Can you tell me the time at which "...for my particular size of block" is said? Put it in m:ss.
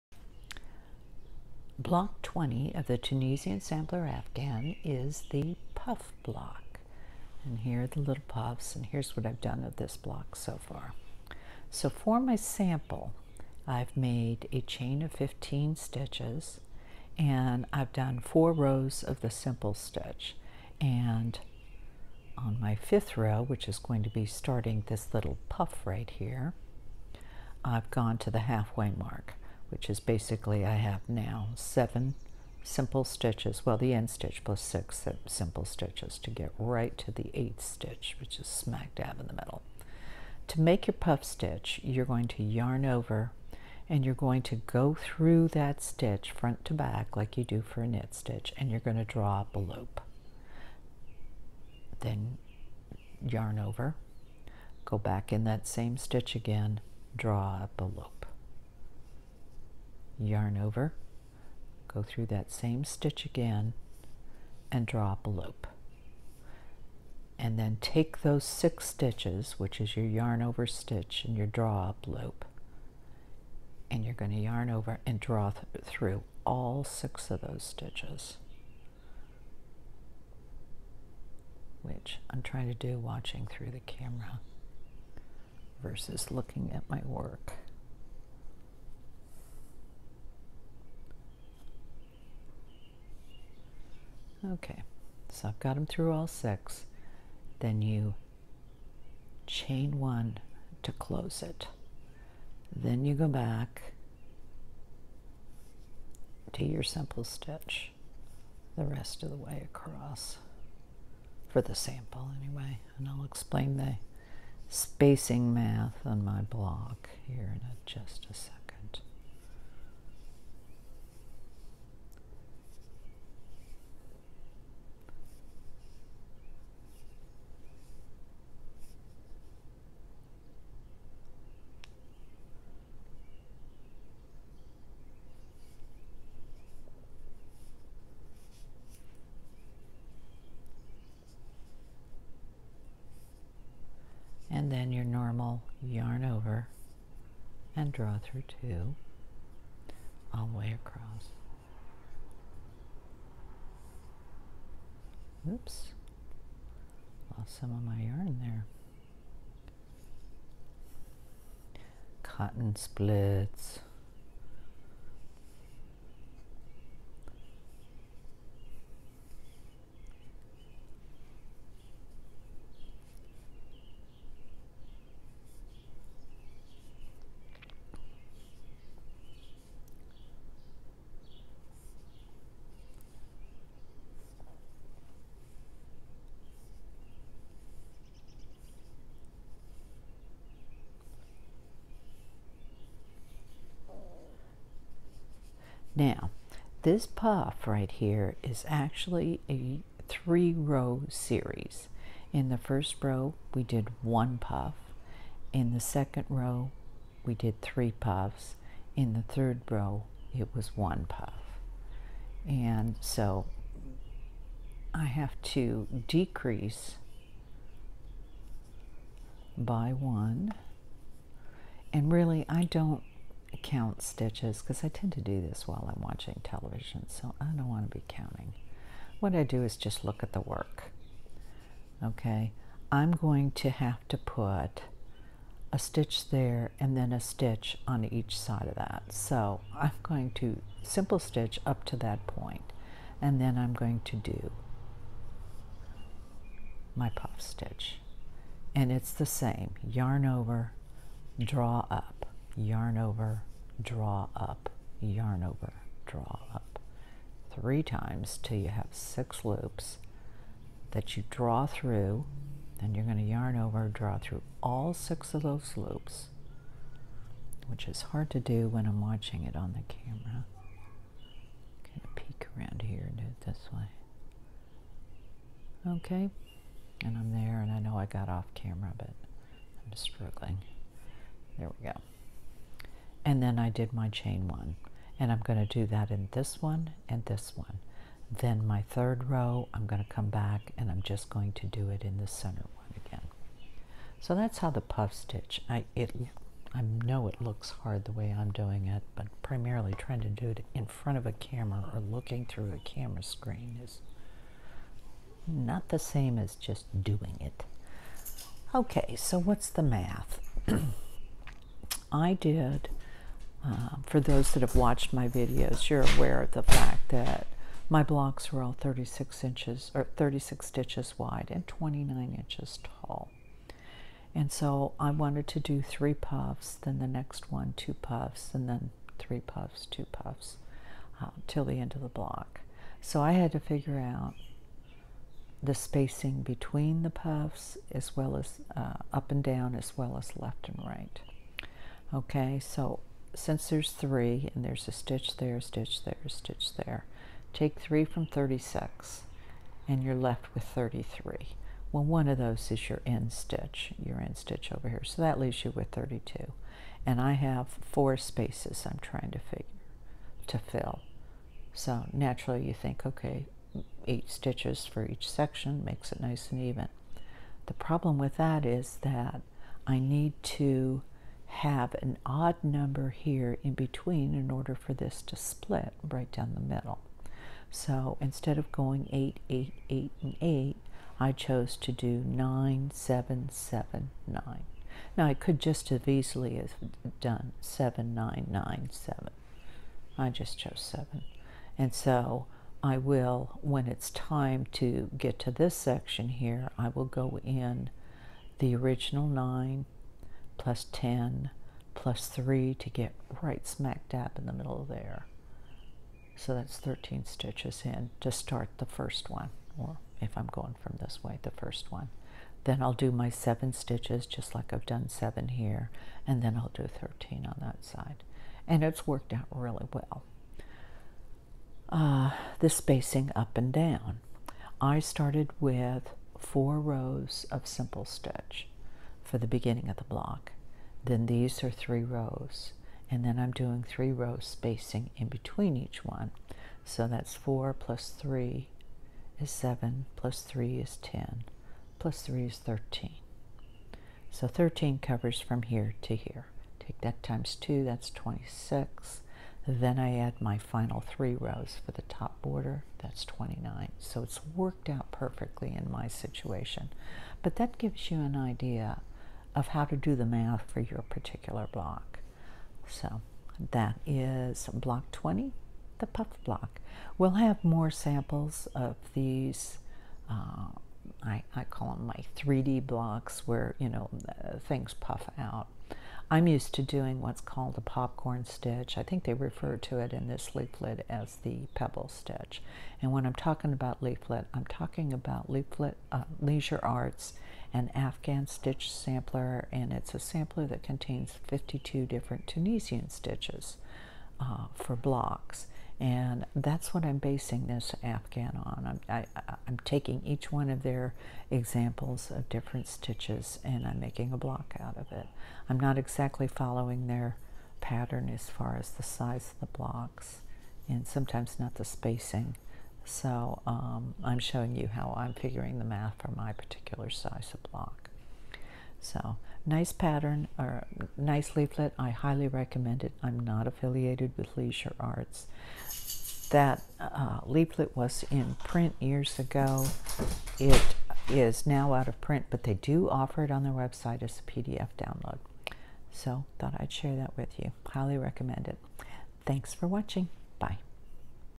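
8:36.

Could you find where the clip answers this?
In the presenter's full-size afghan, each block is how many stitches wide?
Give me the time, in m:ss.
5:20.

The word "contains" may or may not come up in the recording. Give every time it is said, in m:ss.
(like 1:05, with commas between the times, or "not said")
8:10.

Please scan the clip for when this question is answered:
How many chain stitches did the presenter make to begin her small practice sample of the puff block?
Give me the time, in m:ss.
0:15.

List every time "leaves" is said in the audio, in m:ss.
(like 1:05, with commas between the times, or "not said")
5:55.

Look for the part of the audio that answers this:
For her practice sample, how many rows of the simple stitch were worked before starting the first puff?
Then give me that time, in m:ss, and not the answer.
0:18.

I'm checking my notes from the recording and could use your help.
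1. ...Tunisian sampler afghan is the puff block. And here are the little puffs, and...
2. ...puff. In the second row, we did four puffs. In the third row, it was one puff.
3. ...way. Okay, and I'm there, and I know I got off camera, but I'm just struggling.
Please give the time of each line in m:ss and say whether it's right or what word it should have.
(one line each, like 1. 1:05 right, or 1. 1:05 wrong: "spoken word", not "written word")
1. 0:02 right
2. 3:24 wrong: "three", not "four"
3. 4:33 right.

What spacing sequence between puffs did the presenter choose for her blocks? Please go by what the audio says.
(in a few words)
9, 7, 7, 9.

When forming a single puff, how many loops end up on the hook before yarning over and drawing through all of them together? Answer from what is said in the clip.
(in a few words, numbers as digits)
6.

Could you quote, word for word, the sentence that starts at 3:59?
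So I'm going to simple stitch up to that point and then I'm going to do my puff stitch.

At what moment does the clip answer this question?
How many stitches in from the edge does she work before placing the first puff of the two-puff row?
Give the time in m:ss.
6:46.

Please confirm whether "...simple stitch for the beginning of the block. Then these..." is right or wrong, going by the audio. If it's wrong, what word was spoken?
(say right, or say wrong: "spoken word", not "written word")
right.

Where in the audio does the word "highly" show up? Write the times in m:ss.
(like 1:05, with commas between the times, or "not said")
8:42, 8:57.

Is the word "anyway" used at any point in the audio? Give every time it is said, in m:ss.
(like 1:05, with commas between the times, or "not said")
1:52.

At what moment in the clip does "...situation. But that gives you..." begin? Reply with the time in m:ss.
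7:36.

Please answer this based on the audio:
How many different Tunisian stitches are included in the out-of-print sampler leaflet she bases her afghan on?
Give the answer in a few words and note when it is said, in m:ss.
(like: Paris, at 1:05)
52, at 8:11.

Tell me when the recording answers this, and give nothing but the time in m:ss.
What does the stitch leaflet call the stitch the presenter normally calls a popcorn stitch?
8:01.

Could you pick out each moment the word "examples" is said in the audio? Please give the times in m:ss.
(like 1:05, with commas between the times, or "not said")
8:21.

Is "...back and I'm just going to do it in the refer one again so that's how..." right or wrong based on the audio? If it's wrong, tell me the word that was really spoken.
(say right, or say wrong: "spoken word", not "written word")
wrong: "center", not "refer".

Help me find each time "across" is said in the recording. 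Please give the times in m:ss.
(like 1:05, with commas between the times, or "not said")
1:49, 2:30.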